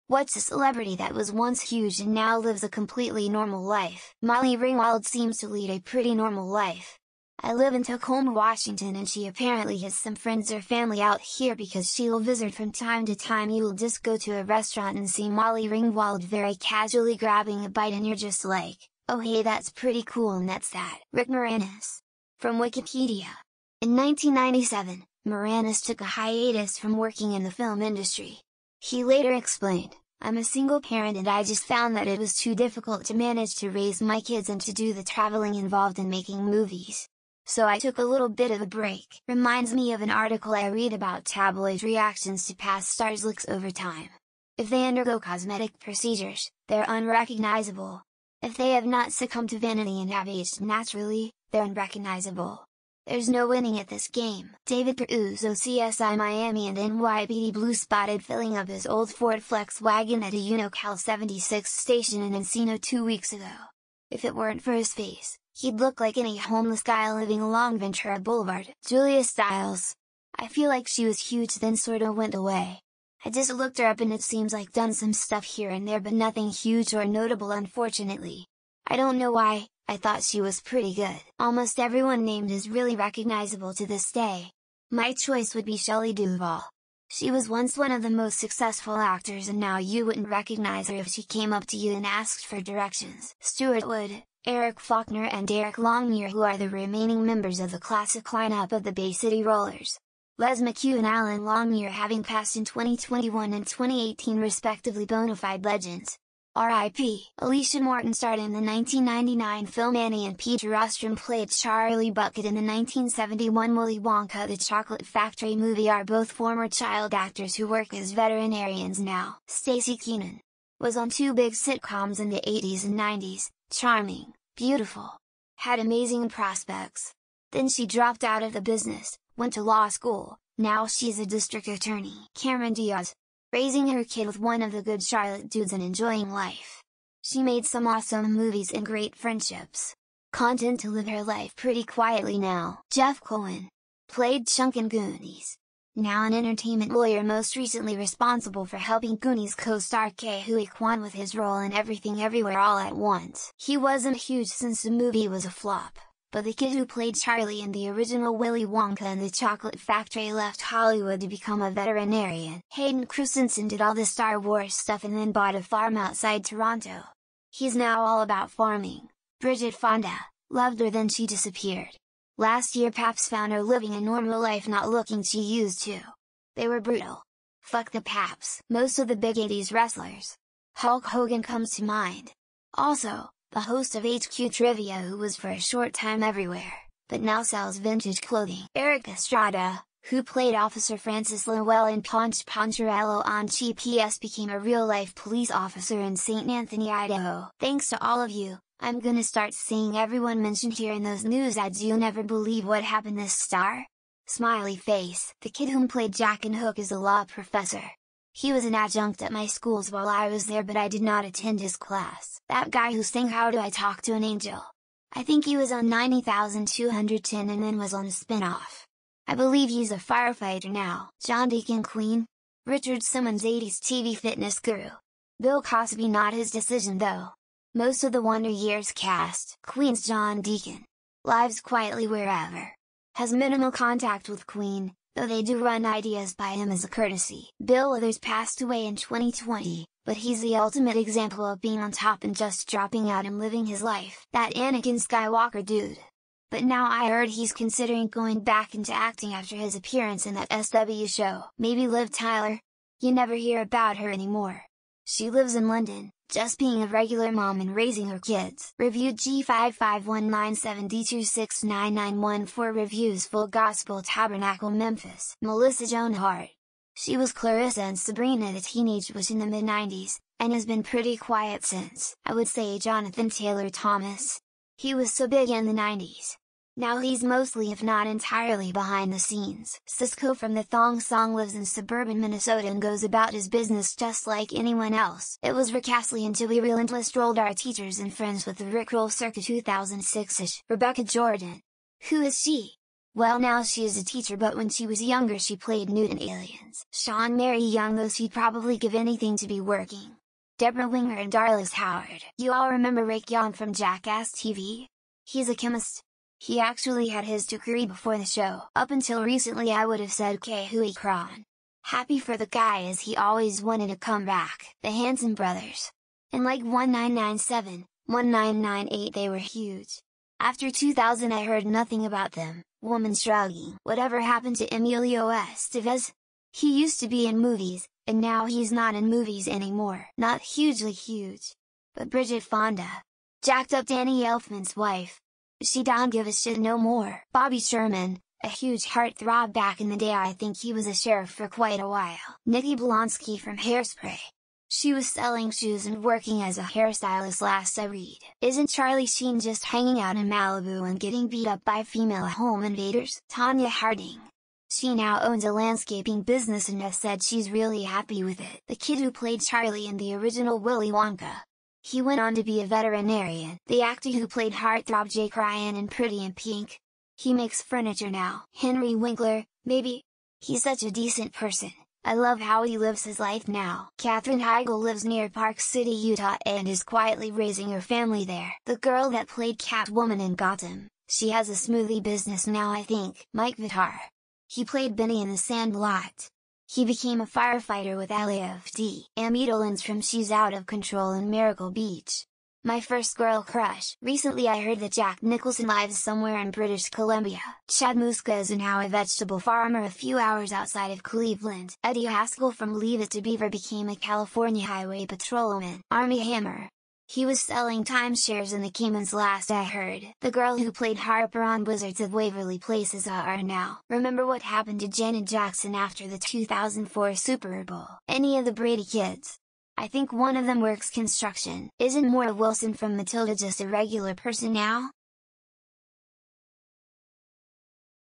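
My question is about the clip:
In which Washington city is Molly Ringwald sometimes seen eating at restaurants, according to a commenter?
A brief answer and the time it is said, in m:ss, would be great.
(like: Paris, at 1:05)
Tacoma, at 0:07.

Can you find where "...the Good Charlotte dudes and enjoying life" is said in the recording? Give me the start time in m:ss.
2:14.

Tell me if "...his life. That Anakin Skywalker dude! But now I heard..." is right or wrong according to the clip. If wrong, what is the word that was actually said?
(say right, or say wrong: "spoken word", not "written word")
right.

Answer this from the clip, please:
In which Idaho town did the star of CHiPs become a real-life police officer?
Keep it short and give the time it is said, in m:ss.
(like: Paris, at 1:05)
St. Anthony, at 3:16.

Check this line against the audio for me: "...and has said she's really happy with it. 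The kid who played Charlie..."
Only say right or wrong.
right.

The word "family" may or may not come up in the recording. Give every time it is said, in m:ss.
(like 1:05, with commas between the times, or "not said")
0:10, 6:17.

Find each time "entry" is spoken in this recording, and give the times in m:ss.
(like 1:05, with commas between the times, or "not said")
not said.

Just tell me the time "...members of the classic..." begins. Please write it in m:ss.
1:37.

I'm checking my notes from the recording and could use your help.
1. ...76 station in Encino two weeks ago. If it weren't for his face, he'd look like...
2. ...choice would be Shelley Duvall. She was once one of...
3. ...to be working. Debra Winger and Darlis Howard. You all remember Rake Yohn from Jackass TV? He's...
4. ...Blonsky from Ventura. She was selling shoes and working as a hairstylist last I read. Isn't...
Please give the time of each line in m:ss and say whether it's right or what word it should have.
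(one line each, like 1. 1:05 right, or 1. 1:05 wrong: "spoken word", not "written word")
1. 1:00 right
2. 1:25 right
3. 4:59 right
4. 5:42 wrong: "Hairspray", not "Ventura".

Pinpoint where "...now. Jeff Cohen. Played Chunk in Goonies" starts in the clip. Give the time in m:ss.
2:22.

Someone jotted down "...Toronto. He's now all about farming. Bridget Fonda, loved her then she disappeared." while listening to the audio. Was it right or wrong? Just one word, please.
right.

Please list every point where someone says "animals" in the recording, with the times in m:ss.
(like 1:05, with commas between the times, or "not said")
not said.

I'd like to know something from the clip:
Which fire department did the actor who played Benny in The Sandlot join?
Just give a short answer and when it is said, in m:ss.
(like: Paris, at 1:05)
LAFD, at 6:28.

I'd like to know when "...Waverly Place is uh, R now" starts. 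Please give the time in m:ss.
6:52.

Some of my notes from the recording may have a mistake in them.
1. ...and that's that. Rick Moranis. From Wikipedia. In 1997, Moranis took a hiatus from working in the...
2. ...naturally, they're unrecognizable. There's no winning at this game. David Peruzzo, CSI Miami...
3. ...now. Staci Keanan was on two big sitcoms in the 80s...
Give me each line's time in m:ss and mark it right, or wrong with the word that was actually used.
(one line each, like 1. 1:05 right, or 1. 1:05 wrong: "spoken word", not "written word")
1. 0:20 right
2. 0:50 right
3. 1:58 right.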